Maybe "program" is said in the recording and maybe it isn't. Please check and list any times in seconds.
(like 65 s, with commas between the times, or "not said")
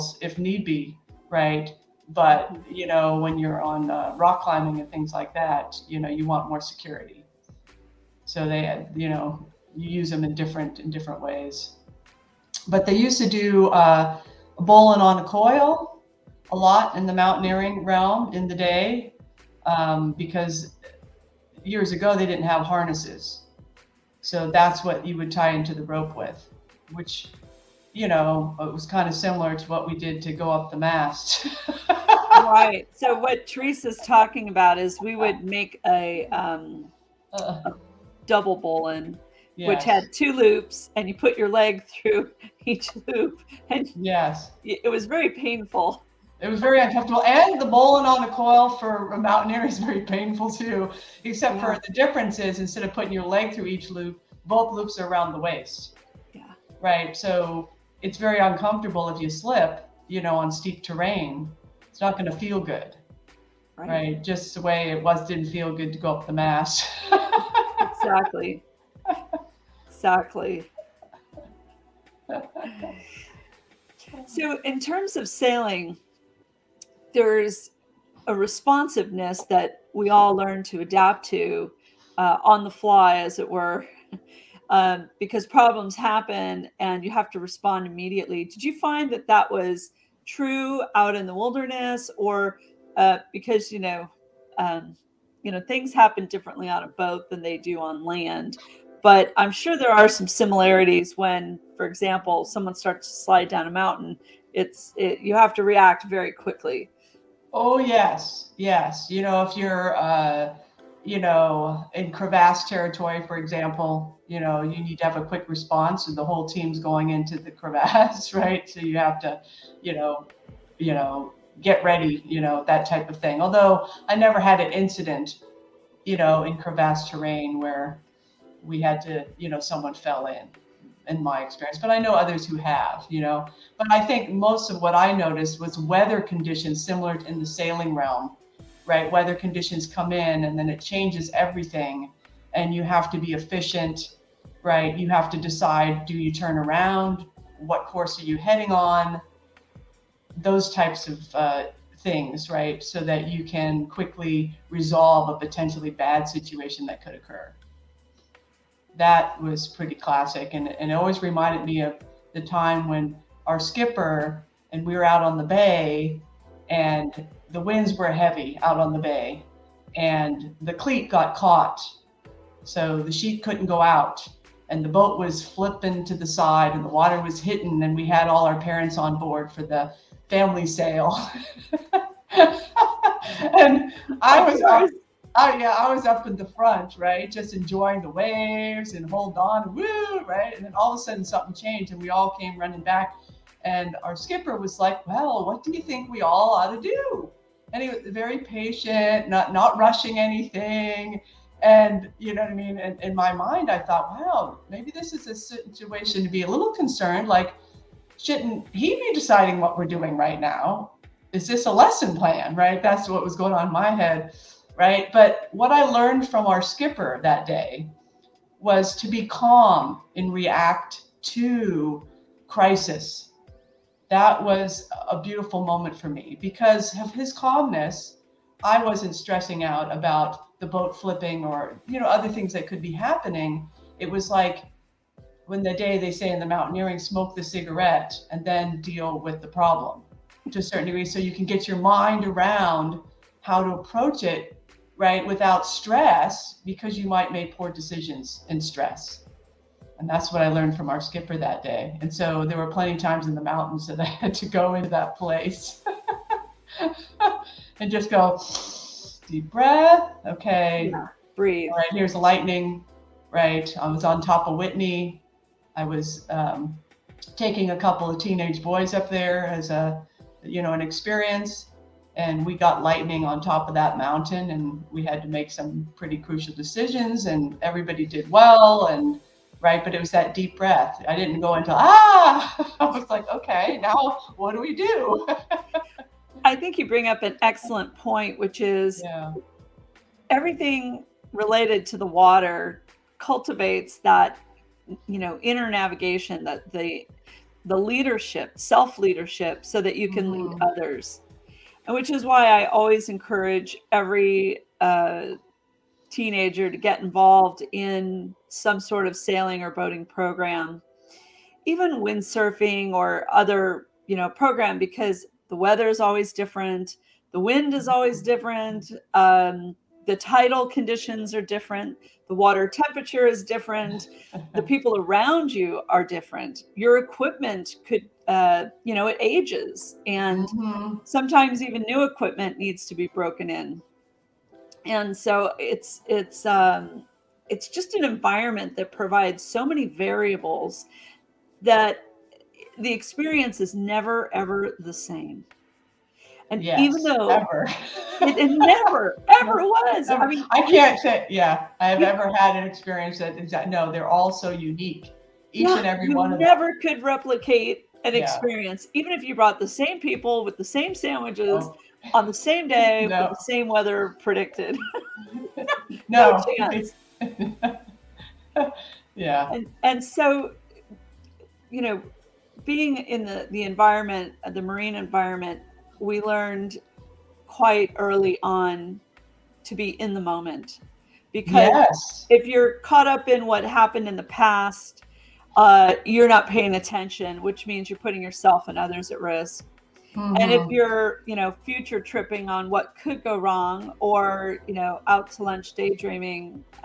310 s, 314 s.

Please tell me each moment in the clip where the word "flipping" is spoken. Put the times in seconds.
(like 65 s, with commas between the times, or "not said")
175 s, 230 s.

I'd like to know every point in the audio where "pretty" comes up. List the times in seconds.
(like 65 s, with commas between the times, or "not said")
159 s, 275 s.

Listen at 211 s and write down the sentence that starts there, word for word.
Is this a lesson plan, right?" That's what was going on in my head right?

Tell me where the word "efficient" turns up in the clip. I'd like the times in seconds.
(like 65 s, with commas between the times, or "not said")
143 s.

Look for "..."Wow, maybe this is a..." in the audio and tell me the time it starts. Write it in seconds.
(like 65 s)
204 s.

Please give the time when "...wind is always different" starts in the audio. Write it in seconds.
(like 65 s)
317 s.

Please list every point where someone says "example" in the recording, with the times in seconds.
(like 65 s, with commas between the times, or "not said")
101 s, 113 s.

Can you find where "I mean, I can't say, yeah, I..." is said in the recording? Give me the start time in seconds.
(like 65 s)
350 s.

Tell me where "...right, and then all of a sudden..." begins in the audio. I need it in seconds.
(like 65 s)
190 s.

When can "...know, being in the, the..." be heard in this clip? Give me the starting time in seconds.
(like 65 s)
371 s.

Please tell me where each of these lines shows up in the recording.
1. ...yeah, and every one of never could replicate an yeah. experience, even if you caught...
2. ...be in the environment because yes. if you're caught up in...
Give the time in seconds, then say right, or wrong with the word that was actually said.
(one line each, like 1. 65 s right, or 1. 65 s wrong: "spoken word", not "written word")
1. 355 s wrong: "brought", not "caught"
2. 379 s wrong: "moment", not "environment".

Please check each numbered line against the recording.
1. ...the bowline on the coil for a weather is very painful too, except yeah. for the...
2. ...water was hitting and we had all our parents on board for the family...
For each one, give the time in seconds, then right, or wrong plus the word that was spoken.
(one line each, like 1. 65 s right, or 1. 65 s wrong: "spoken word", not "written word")
1. 47 s wrong: "mountaineer", not "weather"
2. 176 s right.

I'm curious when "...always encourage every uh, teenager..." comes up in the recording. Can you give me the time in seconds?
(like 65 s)
302 s.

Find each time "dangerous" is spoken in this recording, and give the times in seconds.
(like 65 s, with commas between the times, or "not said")
not said.